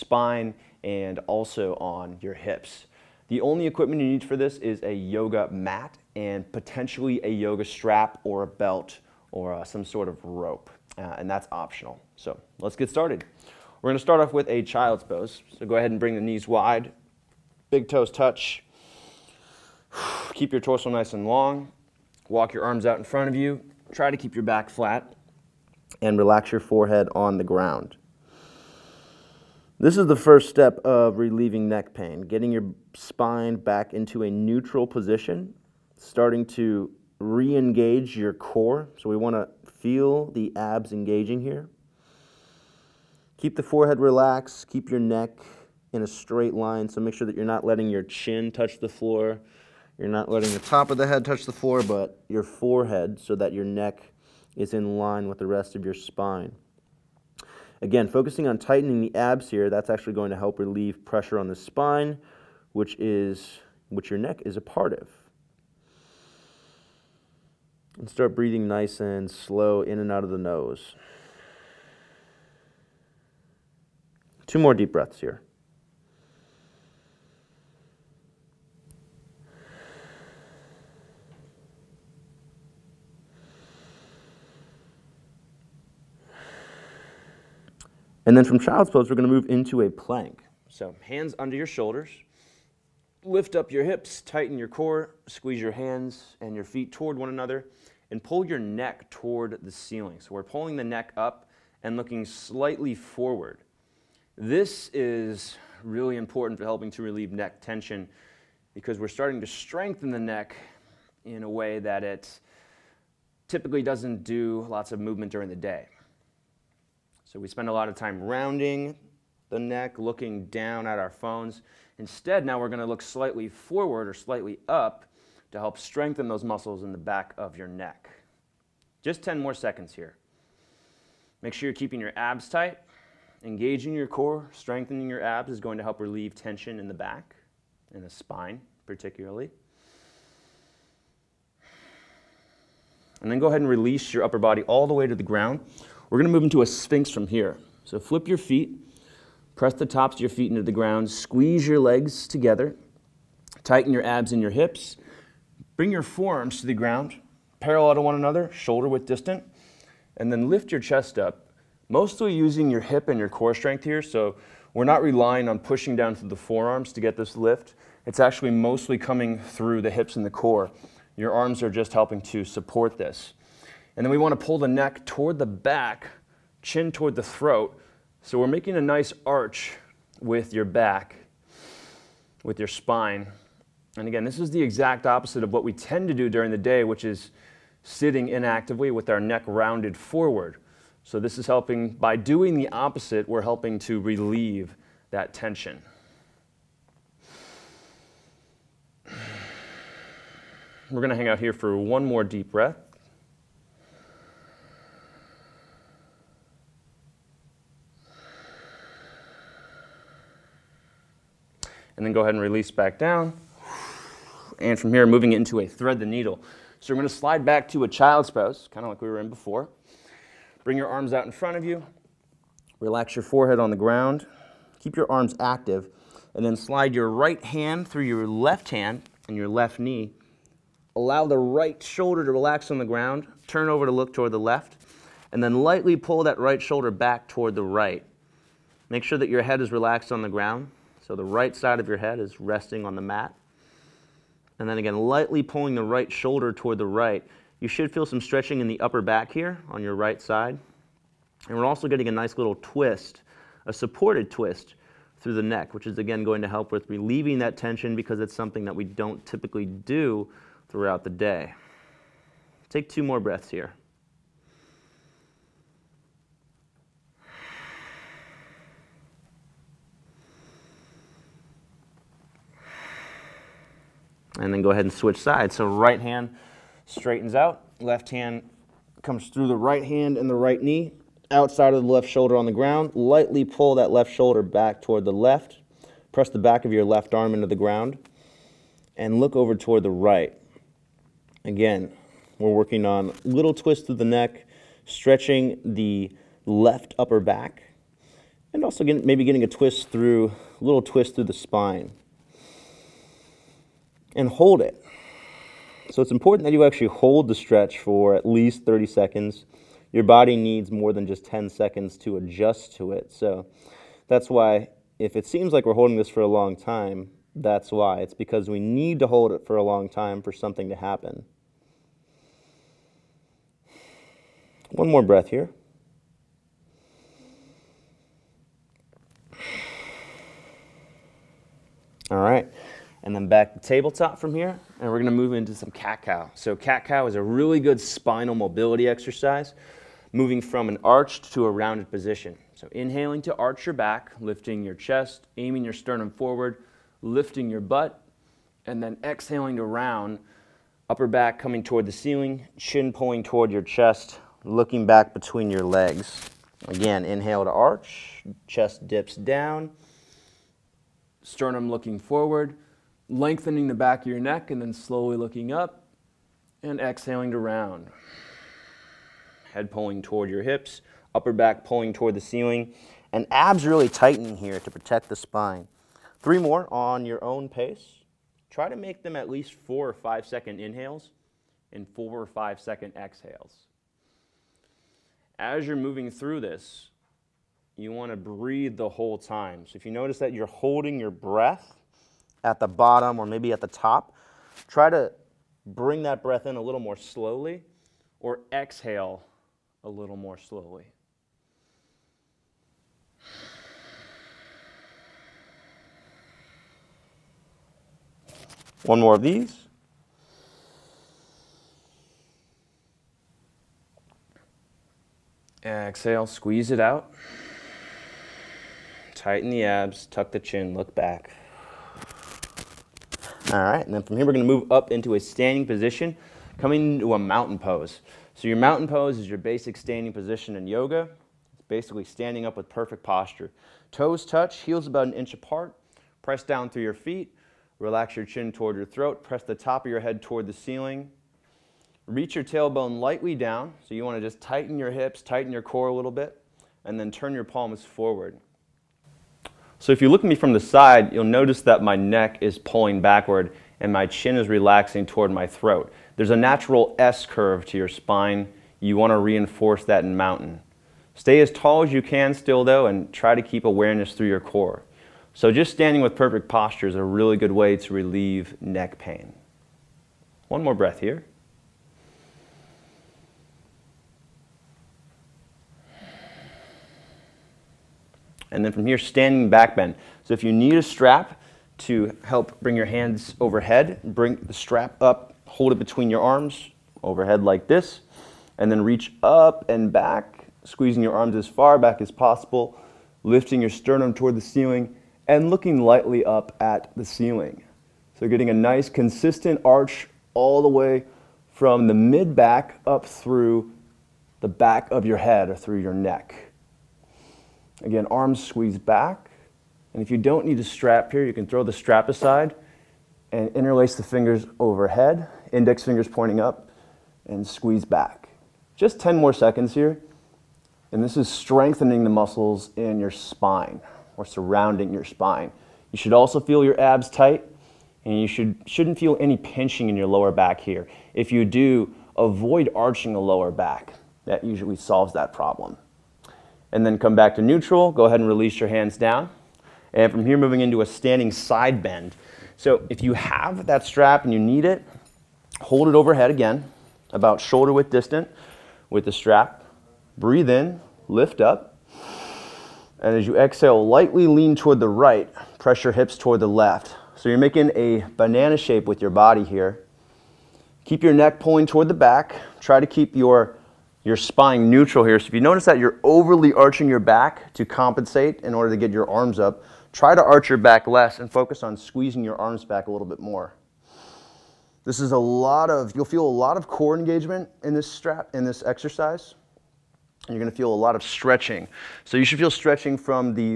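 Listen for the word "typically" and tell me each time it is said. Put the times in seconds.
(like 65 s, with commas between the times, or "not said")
113 s, 259 s.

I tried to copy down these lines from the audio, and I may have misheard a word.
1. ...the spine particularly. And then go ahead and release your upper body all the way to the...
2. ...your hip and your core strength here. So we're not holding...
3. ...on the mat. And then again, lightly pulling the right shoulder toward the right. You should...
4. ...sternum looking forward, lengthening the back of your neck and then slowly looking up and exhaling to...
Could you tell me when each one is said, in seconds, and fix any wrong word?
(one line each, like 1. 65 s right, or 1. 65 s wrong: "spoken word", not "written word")
1. 138 s right
2. 162 s wrong: "relying", not "holding"
3. 242 s right
4. 361 s right.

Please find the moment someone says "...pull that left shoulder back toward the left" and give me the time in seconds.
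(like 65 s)
283 s.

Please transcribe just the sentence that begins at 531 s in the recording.
If you do, avoid arching the lower back.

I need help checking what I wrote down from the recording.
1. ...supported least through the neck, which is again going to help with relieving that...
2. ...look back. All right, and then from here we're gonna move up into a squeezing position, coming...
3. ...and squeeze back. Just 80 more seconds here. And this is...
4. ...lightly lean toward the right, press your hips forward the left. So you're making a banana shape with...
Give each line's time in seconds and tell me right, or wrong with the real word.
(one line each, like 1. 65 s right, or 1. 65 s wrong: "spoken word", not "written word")
1. 253 s wrong: "twist", not "least"
2. 420 s wrong: "standing", not "squeezing"
3. 517 s wrong: "10", not "80"
4. 553 s wrong: "toward", not "forward".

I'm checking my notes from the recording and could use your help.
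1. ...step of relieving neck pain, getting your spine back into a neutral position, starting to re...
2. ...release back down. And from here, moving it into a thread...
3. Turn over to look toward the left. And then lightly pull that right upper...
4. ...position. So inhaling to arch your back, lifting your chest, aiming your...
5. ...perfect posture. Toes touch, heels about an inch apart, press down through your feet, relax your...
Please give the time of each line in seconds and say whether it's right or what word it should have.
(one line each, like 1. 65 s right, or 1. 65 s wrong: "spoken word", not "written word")
1. 30 s right
2. 212 s right
3. 233 s wrong: "shoulder", not "upper"
4. 341 s right
5. 432 s right.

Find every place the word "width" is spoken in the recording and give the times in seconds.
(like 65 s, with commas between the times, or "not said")
158 s, 547 s.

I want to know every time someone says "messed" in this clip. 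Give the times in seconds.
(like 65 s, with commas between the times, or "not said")
not said.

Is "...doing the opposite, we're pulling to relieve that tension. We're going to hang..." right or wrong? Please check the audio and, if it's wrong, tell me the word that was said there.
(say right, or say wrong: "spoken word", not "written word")
wrong: "helping", not "pulling".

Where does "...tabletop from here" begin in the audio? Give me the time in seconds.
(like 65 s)
333 s.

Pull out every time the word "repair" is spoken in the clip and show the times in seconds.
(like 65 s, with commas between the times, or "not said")
not said.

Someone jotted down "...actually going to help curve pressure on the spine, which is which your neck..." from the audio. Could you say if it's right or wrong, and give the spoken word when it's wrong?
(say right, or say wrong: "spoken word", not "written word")
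wrong: "relieve", not "curve".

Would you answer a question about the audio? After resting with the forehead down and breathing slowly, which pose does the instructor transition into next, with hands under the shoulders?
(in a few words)
plank.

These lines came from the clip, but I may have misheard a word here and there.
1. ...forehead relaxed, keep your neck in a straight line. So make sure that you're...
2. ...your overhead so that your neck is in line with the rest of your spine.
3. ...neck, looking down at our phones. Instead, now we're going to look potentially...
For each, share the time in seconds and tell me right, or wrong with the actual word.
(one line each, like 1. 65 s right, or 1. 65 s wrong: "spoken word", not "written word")
1. 43 s right
2. 52 s wrong: "forehead", not "overhead"
3. 119 s wrong: "slightly", not "potentially".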